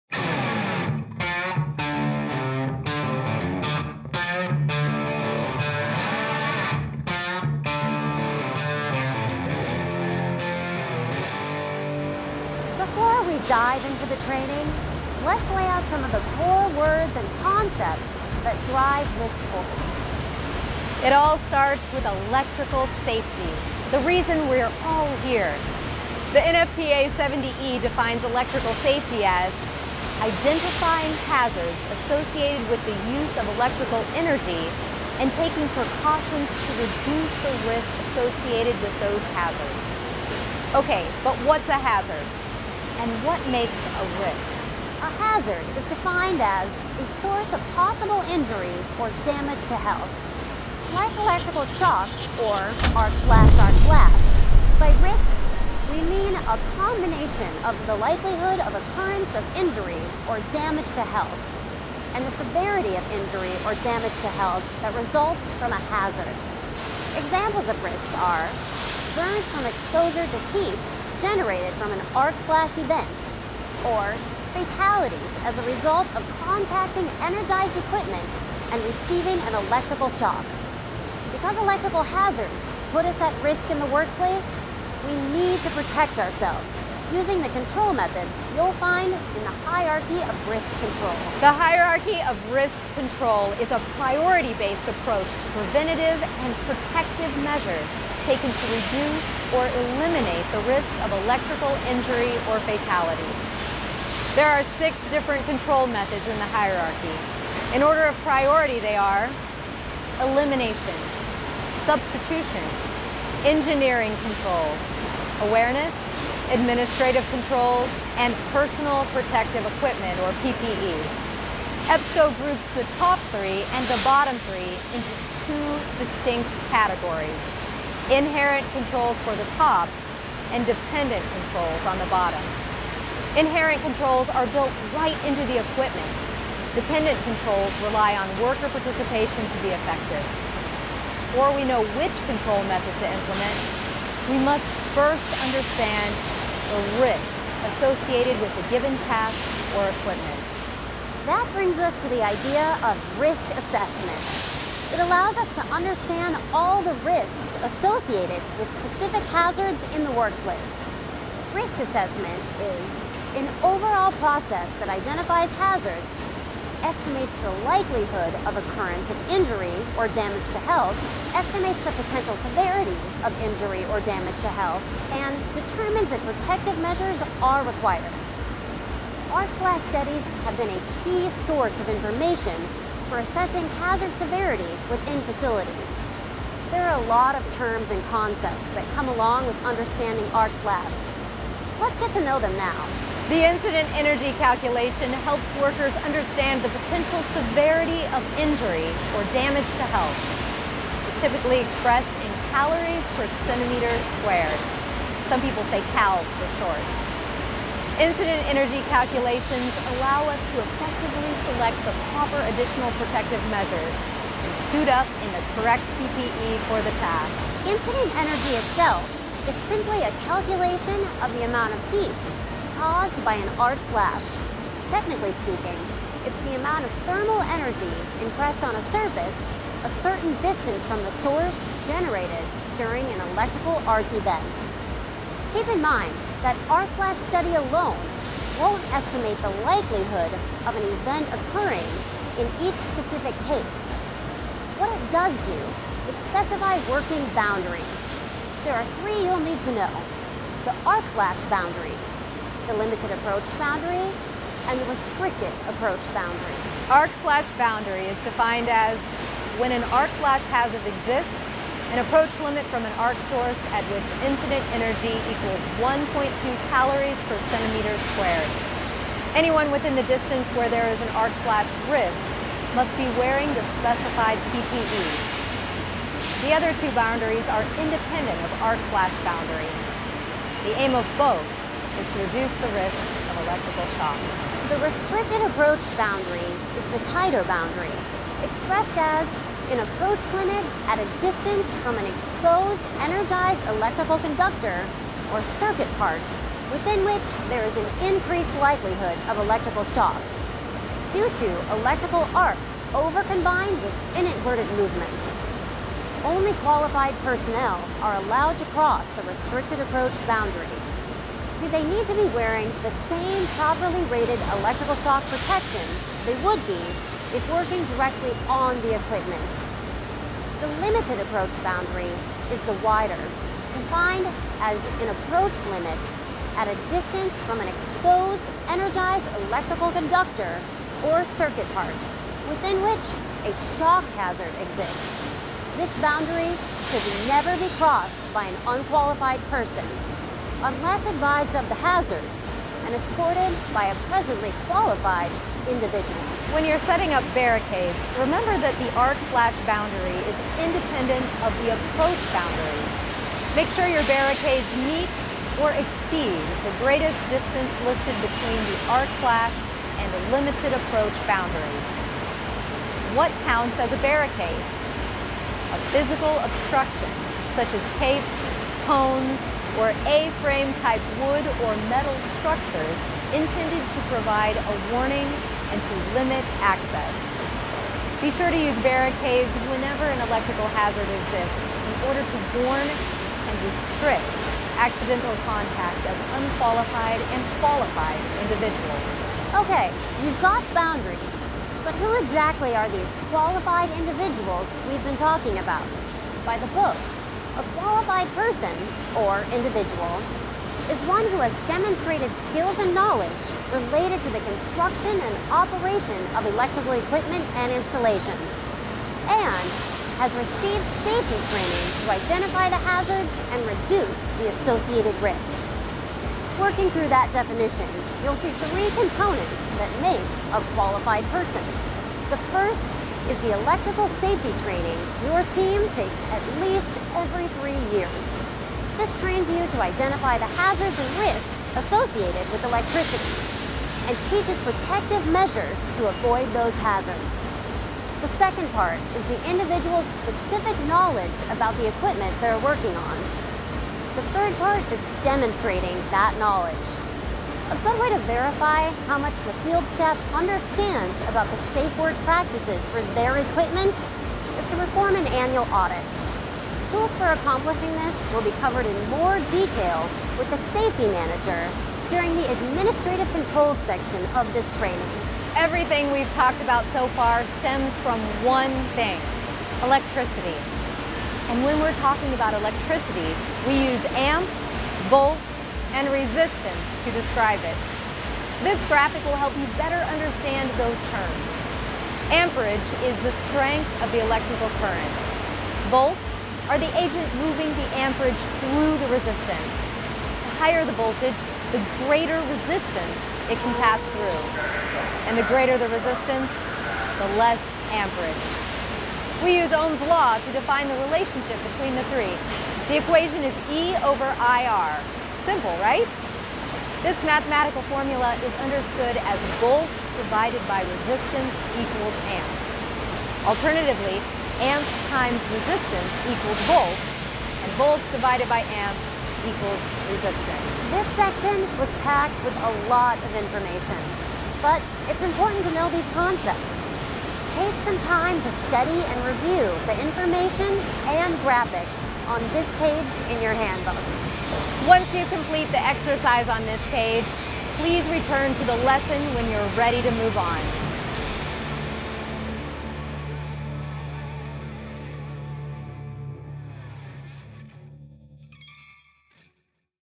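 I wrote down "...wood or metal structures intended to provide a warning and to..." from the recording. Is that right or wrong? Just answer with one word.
right.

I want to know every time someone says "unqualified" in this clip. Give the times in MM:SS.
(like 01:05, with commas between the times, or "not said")
05:38, 06:26.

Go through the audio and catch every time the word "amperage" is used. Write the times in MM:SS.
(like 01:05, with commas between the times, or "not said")
08:02, 08:07, 08:17.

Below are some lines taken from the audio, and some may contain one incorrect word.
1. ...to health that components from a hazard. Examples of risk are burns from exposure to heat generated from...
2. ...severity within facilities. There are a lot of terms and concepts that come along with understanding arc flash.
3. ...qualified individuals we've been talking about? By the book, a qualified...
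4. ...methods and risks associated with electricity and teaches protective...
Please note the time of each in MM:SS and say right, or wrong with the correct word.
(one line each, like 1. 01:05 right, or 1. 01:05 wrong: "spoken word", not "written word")
1. 01:04 wrong: "results", not "components"
2. 03:04 right
3. 06:33 right
4. 07:10 wrong: "hazards", not "methods".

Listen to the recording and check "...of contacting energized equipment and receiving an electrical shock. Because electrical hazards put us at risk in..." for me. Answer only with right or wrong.
right.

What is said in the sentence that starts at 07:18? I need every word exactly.
The second part is the individual's specific knowledge about the equipment they're working on.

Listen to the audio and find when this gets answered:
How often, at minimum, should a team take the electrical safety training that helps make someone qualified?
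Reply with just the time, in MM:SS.
07:07.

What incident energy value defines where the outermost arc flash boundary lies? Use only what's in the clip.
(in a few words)
1.2 calories per centimeter squared.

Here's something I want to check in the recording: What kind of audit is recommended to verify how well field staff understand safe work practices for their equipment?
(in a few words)
annual audit.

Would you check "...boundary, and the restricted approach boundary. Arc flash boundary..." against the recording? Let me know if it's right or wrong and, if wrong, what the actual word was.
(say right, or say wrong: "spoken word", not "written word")
right.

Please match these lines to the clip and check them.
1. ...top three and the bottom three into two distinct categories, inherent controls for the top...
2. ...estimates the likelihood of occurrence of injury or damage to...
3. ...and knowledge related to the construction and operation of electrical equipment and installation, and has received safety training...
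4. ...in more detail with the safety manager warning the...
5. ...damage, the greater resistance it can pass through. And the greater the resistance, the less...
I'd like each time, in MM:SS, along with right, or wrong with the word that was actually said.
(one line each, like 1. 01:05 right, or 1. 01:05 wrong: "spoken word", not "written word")
1. 02:02 right
2. 02:46 right
3. 06:42 right
4. 07:38 wrong: "during", not "warning"
5. 08:10 wrong: "voltage", not "damage".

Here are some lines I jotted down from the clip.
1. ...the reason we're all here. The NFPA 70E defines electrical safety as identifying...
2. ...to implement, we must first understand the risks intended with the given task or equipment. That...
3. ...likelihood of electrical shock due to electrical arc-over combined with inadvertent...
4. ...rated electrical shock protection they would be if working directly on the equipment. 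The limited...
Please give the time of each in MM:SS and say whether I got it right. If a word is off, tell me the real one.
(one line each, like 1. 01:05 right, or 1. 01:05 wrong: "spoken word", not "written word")
1. 00:23 right
2. 02:22 wrong: "associated", not "intended"
3. 04:58 right
4. 05:14 right.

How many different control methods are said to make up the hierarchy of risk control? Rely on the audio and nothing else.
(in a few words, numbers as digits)
6.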